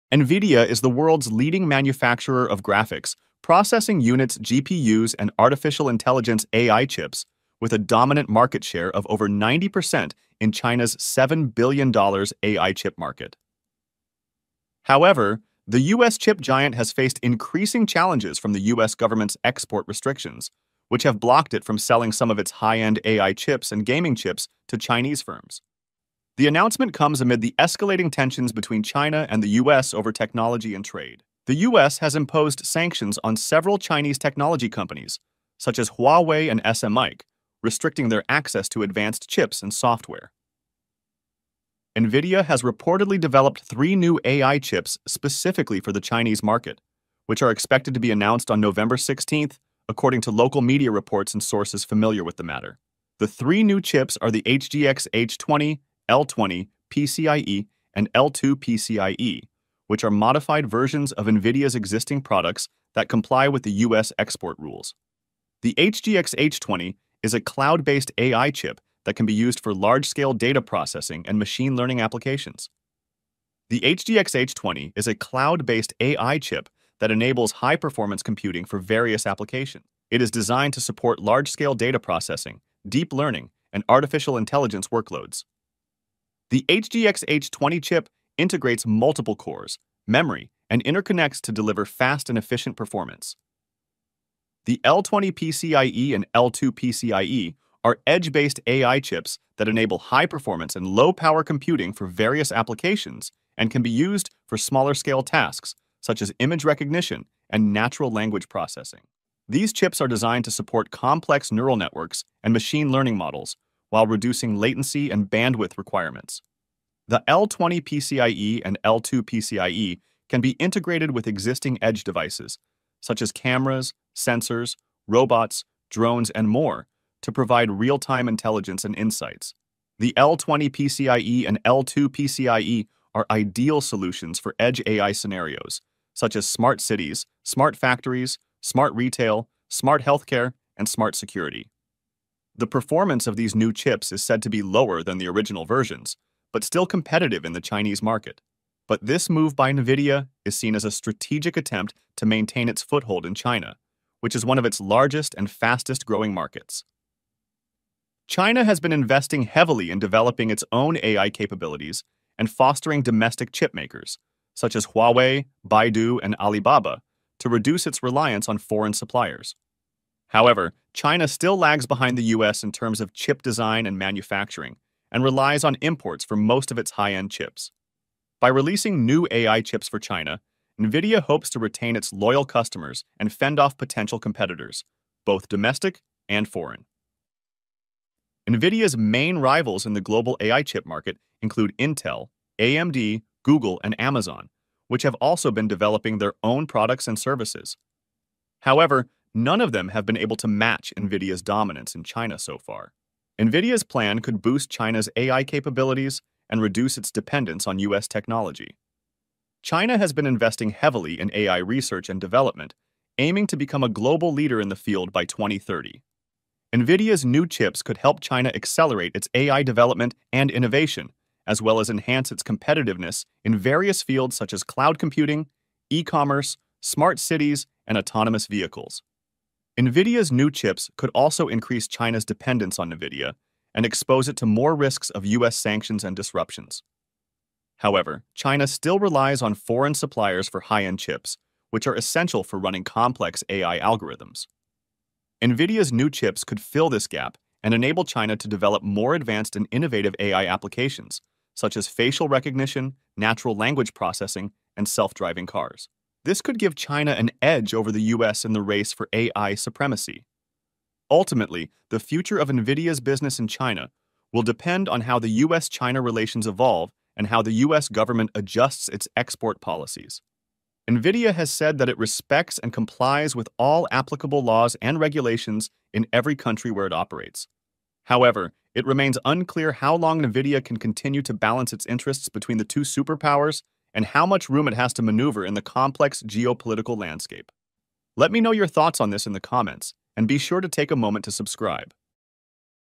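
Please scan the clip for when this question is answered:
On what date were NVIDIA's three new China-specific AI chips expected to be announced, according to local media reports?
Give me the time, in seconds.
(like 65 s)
48 s.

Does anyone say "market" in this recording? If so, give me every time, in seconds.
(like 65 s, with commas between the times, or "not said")
8 s, 12 s, 46 s, 148 s, 156 s, 190 s.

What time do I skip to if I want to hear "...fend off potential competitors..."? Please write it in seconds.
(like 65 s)
183 s.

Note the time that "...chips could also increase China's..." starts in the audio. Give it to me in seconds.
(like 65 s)
230 s.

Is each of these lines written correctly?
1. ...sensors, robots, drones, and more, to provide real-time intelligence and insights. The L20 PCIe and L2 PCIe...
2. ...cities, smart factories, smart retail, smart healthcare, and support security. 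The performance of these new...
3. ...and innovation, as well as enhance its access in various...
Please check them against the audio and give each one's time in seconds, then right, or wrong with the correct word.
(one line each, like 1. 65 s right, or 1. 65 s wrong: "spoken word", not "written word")
1. 124 s right
2. 136 s wrong: "smart", not "support"
3. 220 s wrong: "competitiveness", not "access".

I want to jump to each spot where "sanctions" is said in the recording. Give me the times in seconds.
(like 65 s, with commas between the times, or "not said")
32 s, 235 s.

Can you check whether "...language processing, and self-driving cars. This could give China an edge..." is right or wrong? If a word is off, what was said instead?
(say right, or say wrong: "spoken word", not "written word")
right.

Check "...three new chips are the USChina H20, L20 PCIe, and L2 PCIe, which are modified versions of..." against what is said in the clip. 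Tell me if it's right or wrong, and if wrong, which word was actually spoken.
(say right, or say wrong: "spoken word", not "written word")
wrong: "HGX", not "USChina".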